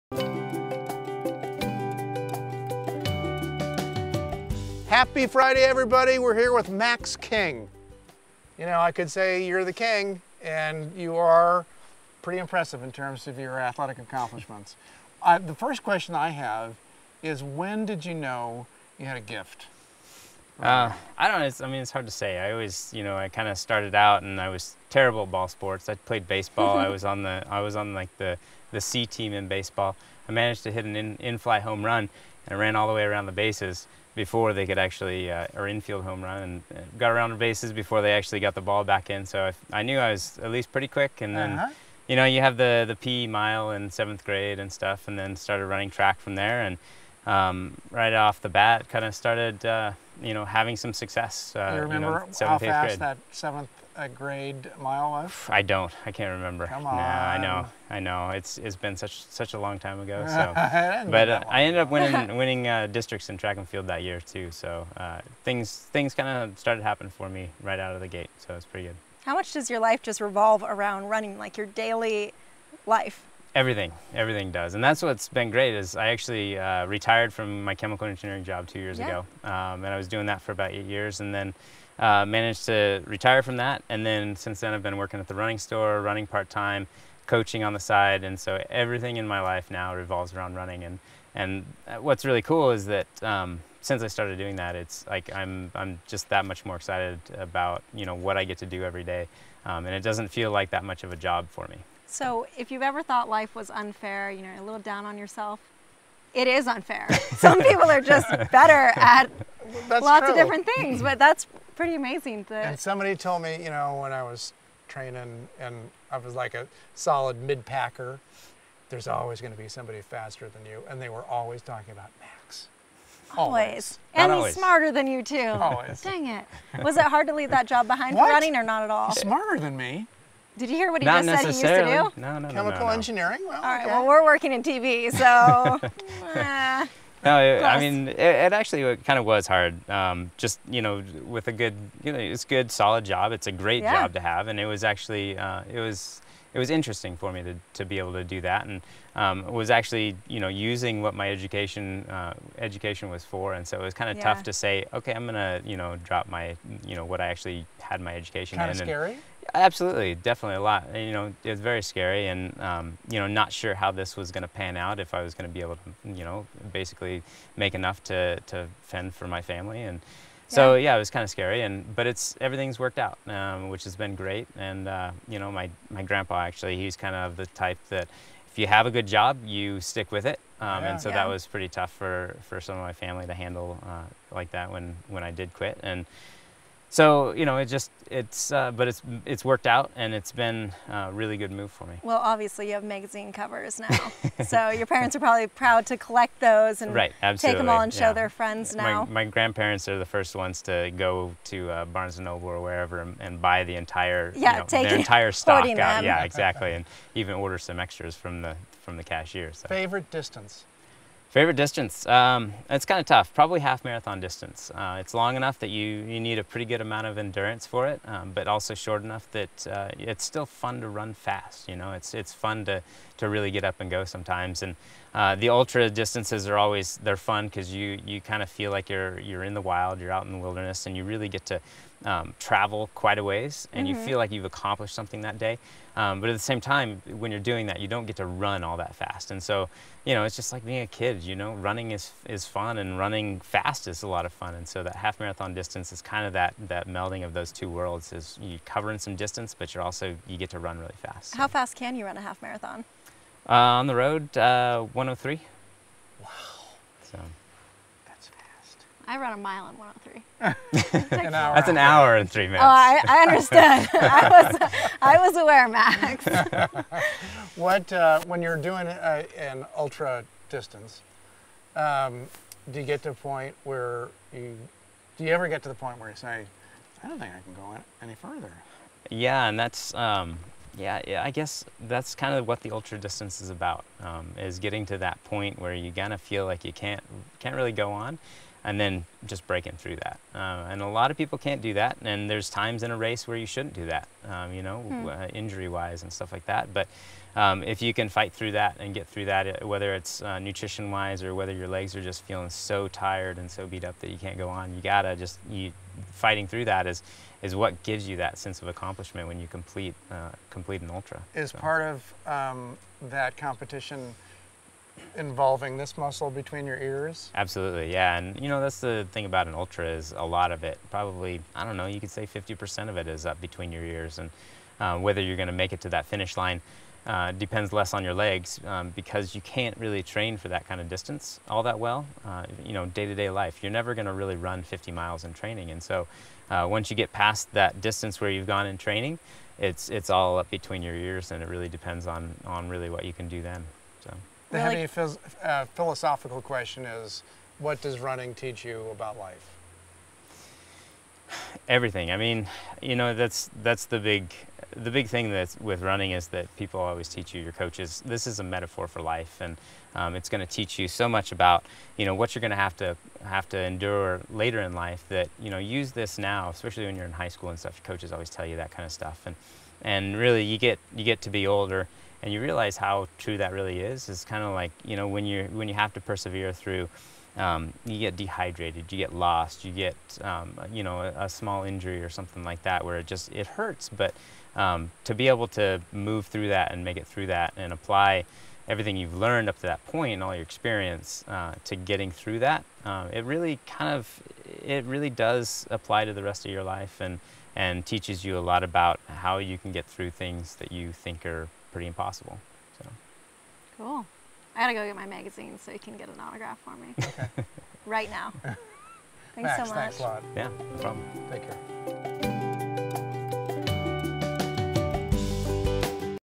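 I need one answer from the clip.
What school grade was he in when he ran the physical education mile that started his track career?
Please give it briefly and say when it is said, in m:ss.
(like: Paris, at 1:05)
Seventh grade, at 0:43.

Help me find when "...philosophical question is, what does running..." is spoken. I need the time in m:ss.
5:45.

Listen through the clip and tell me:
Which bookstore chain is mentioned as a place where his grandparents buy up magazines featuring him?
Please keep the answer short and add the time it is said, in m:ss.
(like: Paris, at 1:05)
Barnes and Noble, at 3:21.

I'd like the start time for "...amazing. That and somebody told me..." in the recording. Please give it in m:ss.
1:51.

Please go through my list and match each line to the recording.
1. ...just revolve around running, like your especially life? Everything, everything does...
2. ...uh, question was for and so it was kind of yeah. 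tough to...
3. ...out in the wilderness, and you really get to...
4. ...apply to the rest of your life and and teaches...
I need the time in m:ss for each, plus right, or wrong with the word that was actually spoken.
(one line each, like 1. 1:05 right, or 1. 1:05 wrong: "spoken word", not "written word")
1. 1:10 wrong: "daily", not "especially"
2. 2:32 wrong: "education", not "question"
3. 3:50 right
4. 6:35 right.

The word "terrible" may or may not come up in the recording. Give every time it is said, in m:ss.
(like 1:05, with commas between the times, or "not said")
0:24.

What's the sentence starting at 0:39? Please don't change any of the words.
So I, I knew I was at least pretty quick.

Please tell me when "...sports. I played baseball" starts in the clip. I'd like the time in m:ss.
0:25.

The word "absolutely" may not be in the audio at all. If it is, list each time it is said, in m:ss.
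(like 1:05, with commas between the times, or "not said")
2:39, 3:17, 5:17.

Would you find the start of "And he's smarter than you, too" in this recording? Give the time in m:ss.
2:04.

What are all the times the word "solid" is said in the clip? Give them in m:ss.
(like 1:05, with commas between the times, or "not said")
1:56, 2:22.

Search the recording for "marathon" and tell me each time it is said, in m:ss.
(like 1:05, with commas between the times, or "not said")
3:33, 4:05, 4:12.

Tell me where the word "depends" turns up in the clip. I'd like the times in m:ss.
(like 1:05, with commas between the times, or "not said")
5:27, 5:41.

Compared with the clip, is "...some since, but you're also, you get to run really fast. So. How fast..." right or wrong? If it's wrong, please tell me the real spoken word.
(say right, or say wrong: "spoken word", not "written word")
wrong: "distance", not "since".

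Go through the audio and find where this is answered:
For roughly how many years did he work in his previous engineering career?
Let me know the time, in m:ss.
1:20.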